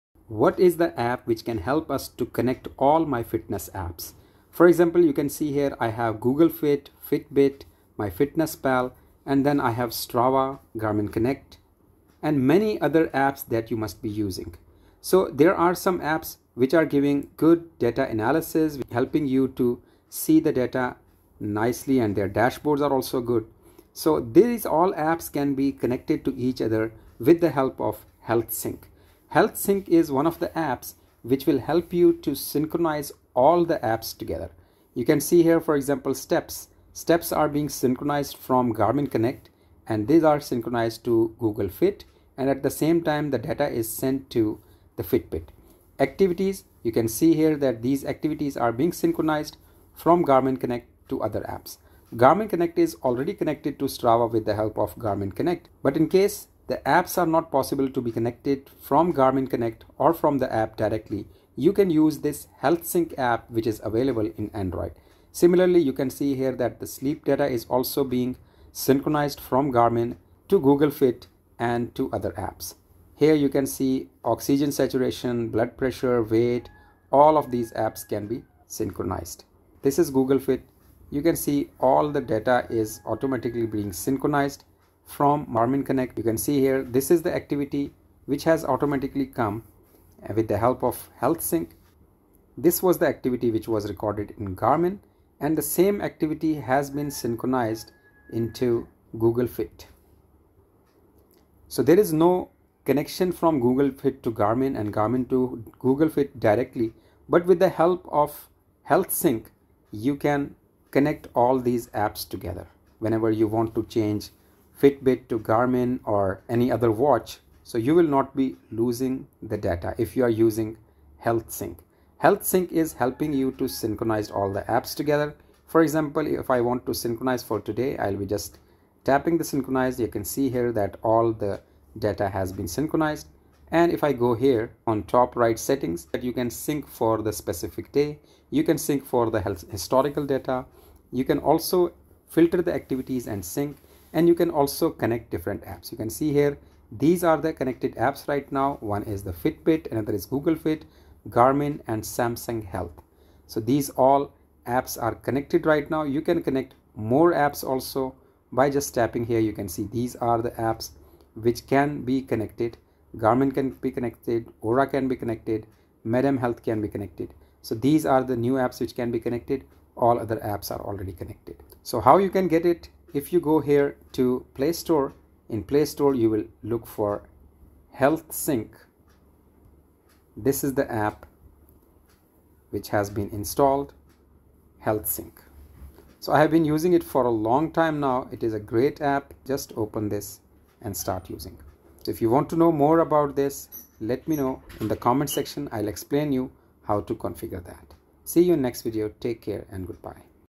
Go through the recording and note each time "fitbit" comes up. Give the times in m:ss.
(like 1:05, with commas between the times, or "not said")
0:07, 0:45, 1:54, 2:29.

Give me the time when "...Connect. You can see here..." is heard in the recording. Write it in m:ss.
1:25.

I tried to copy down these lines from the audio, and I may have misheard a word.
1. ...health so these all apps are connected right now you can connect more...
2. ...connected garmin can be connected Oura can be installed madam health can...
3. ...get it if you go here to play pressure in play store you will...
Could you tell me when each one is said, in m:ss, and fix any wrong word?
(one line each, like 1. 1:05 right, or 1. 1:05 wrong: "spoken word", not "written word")
1. 2:32 right
2. 2:42 wrong: "connected", not "installed"
3. 2:52 wrong: "store", not "pressure".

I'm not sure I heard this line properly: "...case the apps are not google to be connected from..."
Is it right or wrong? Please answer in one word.
wrong.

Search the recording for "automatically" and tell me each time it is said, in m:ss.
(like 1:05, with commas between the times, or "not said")
1:23, 1:28.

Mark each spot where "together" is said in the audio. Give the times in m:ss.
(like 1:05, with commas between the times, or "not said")
0:34, 1:52, 2:04.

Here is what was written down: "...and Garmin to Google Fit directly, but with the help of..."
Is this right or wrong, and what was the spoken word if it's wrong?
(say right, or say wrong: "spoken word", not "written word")
right.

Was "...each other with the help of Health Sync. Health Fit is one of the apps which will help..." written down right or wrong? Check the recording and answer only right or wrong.
wrong.